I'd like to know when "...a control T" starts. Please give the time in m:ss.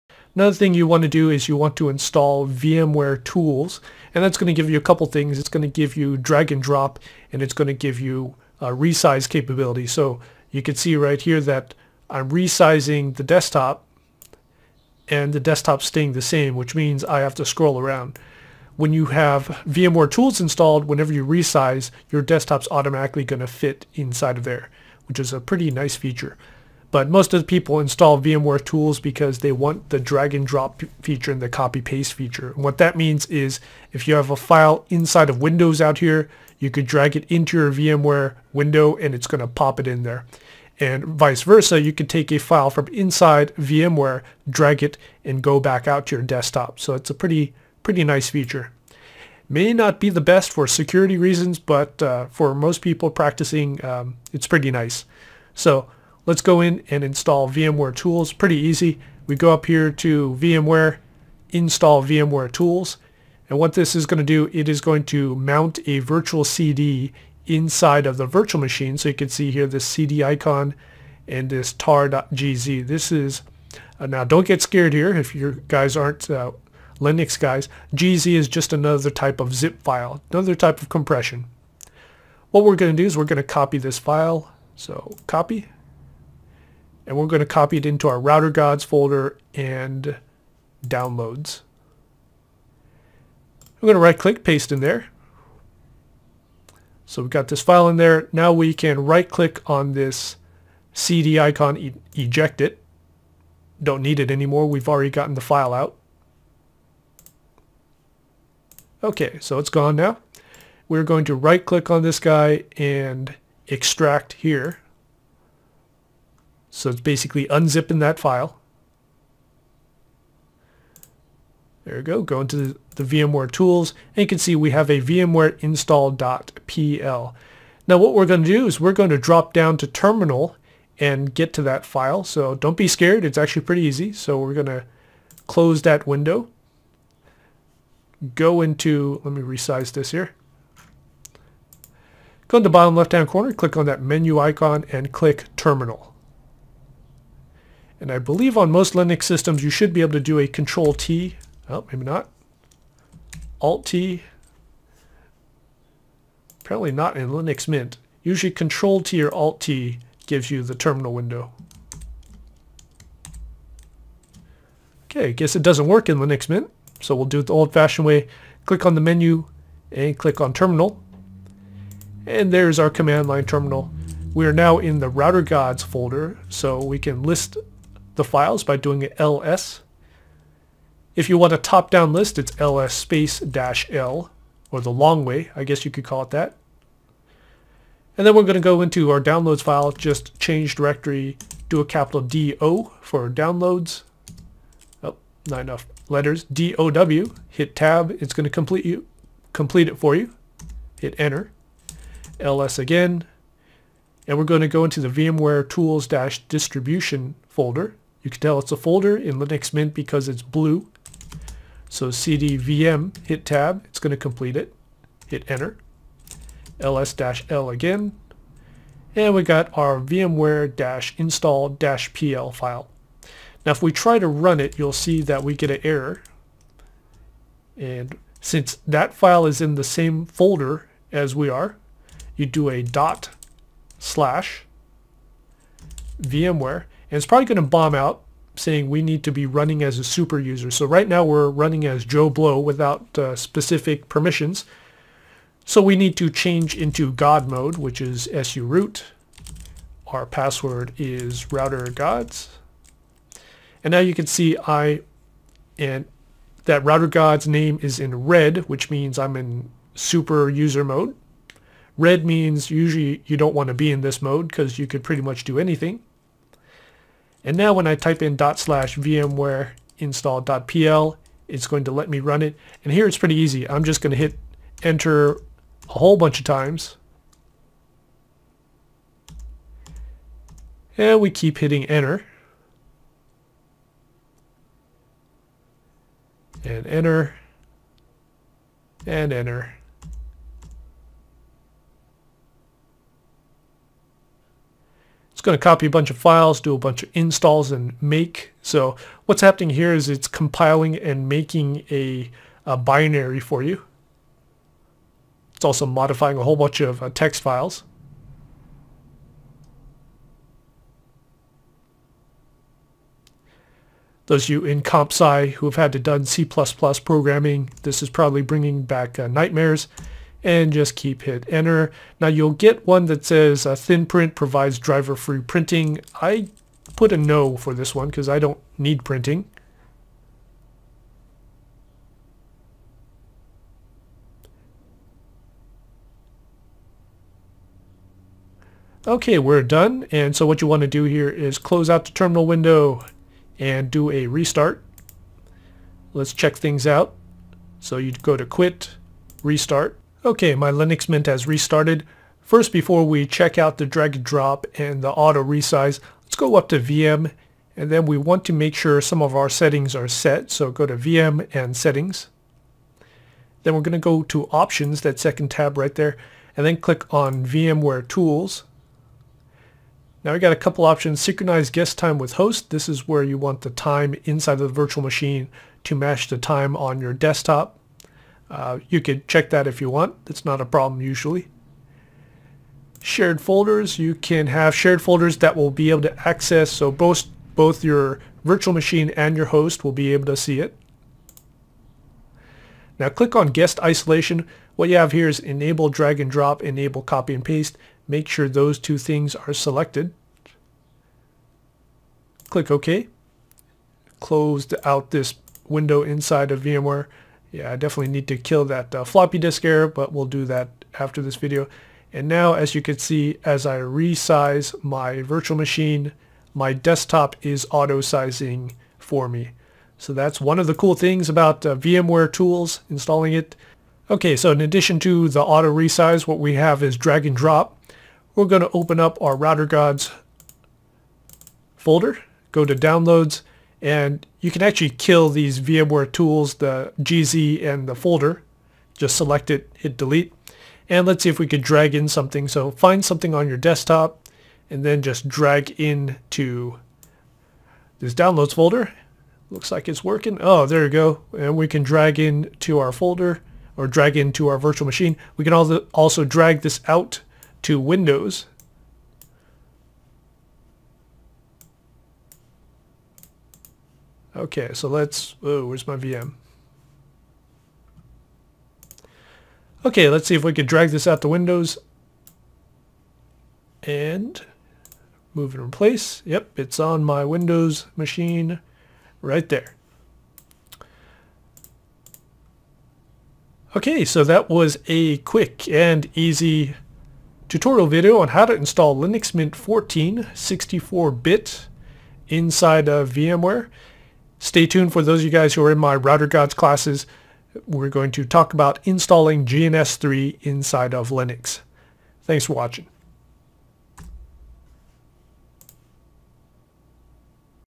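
2:30.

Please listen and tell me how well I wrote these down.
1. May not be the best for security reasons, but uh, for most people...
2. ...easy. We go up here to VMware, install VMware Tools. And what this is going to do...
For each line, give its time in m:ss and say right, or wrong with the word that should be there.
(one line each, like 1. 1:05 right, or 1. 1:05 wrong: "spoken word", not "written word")
1. 0:49 right
2. 0:58 right.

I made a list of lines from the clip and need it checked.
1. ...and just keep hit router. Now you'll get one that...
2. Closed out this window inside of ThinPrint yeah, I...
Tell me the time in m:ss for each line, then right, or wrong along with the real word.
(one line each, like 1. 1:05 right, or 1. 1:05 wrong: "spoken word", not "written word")
1. 5:20 wrong: "enter", not "router"
2. 6:44 wrong: "VMware", not "ThinPrint".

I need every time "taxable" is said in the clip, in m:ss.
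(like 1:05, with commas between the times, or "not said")
not said.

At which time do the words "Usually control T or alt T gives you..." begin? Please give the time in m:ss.
2:38.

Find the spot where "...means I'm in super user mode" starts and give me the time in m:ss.
4:18.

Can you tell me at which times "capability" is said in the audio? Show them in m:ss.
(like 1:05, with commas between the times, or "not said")
0:09.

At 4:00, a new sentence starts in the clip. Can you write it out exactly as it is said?
So right now we're running as Joe Blow without uh, specific permissions.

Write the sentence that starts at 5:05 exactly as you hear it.
It's also modifying a whole bunch of uh, text files.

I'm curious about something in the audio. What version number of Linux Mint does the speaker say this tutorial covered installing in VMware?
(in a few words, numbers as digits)
14.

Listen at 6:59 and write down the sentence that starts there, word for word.
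So that's one of the cool things about uh, VMware tools, installing it.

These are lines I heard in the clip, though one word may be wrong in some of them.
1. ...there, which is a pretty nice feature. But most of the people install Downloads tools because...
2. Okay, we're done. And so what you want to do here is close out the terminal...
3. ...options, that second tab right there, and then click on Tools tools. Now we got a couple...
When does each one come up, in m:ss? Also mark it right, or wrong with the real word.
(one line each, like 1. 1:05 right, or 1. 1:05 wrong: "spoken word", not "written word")
1. 0:24 wrong: "VMware", not "Downloads"
2. 5:39 right
3. 6:04 wrong: "VMware", not "Tools".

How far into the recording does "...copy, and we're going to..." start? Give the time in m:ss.
1:25.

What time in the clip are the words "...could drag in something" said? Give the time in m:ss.
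7:21.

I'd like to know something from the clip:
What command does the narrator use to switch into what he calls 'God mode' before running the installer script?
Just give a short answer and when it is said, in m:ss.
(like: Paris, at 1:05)
su root, at 4:08.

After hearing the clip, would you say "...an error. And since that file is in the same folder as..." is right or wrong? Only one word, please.
right.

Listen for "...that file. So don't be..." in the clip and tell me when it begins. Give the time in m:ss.
2:11.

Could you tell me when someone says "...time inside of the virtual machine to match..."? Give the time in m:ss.
6:13.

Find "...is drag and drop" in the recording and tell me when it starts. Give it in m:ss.
7:06.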